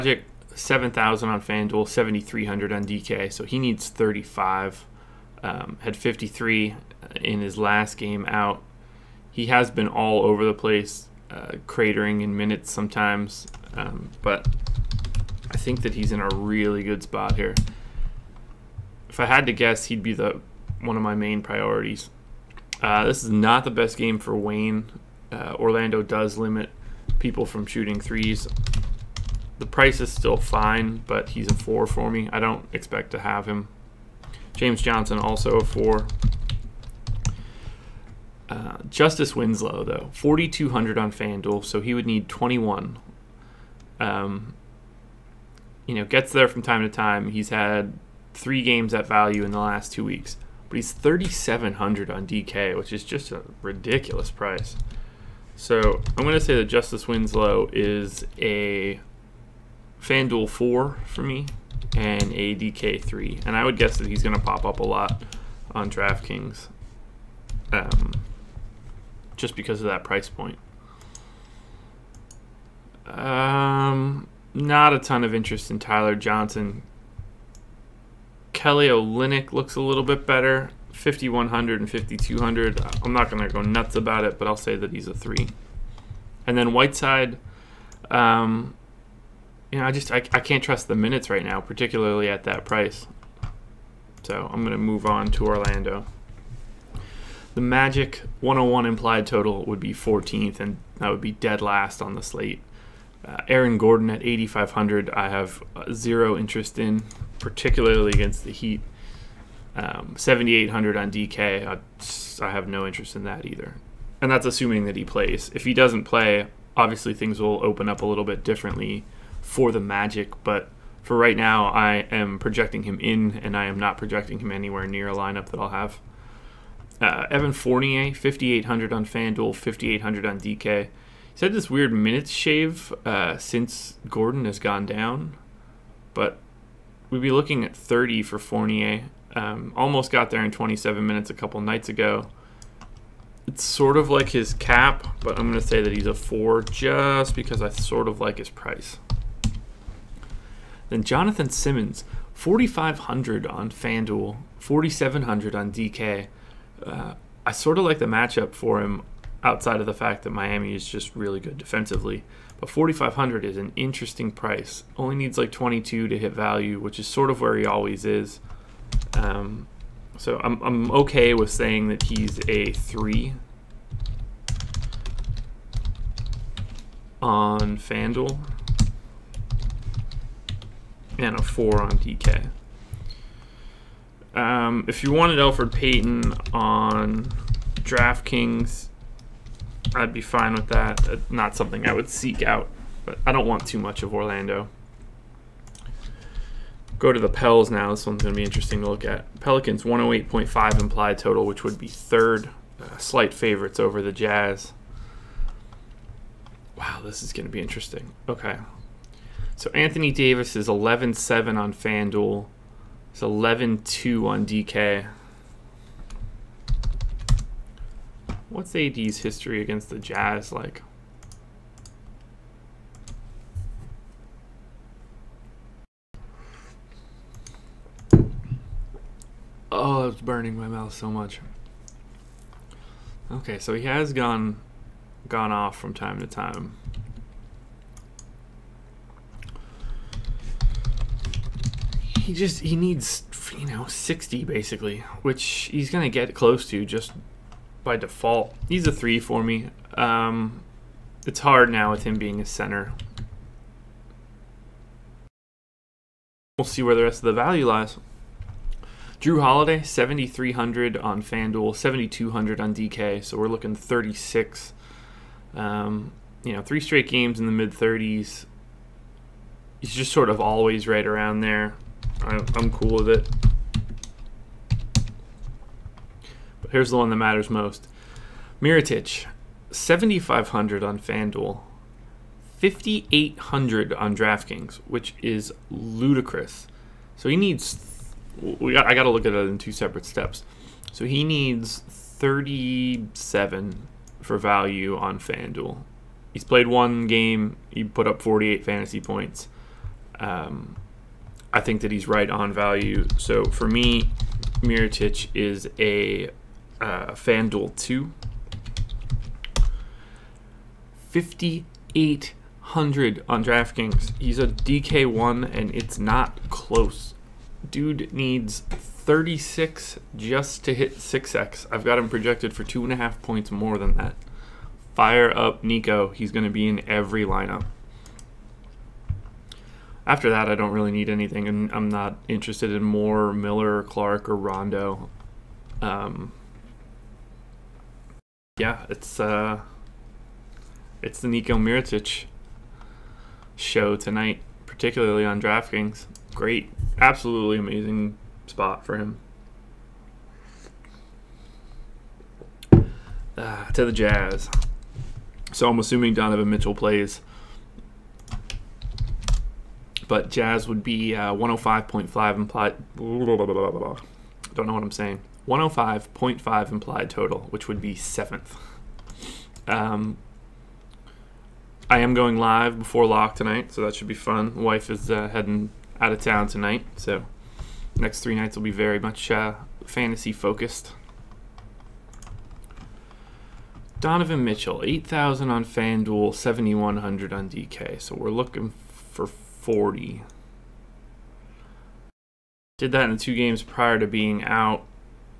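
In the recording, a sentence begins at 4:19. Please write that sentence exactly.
Jrue Holiday, 7,300 on FanDuel, 7,200 on DK, so we're looking 36.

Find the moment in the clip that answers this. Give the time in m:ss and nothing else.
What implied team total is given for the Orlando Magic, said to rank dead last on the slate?
1:38.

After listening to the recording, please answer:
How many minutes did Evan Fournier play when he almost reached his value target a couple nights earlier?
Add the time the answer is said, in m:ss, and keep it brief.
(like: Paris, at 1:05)
27, at 2:20.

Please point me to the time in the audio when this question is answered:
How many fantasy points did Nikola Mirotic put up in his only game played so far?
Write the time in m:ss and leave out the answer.
4:58.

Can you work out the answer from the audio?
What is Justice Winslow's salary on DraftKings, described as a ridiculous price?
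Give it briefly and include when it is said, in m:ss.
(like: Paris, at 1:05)
$3,700, at 0:50.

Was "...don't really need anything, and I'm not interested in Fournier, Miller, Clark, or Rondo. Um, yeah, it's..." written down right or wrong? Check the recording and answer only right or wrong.
wrong.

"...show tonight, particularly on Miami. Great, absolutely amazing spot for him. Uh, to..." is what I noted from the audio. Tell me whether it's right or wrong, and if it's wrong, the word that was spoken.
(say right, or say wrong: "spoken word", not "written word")
wrong: "DraftKings", not "Miami".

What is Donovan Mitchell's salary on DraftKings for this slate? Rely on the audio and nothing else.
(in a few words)
$7,100.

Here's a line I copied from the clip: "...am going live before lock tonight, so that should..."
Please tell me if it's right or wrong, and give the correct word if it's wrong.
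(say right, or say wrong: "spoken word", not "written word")
right.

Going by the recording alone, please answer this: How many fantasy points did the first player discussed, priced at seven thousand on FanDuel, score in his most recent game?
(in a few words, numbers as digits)
53.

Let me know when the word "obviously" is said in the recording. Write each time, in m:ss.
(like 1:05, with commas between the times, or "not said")
1:56.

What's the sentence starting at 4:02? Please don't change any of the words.
he just he needs you know 60 basically, which he's gonna get close to just by default.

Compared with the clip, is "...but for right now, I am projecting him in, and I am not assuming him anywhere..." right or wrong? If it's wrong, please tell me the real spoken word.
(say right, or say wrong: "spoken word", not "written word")
wrong: "projecting", not "assuming".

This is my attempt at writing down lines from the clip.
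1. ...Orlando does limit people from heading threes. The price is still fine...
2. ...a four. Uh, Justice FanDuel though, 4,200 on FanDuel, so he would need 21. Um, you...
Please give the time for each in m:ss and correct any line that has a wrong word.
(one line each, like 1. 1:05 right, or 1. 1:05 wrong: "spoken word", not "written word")
1. 0:25 wrong: "shooting", not "heading"
2. 0:35 wrong: "Winslow", not "FanDuel".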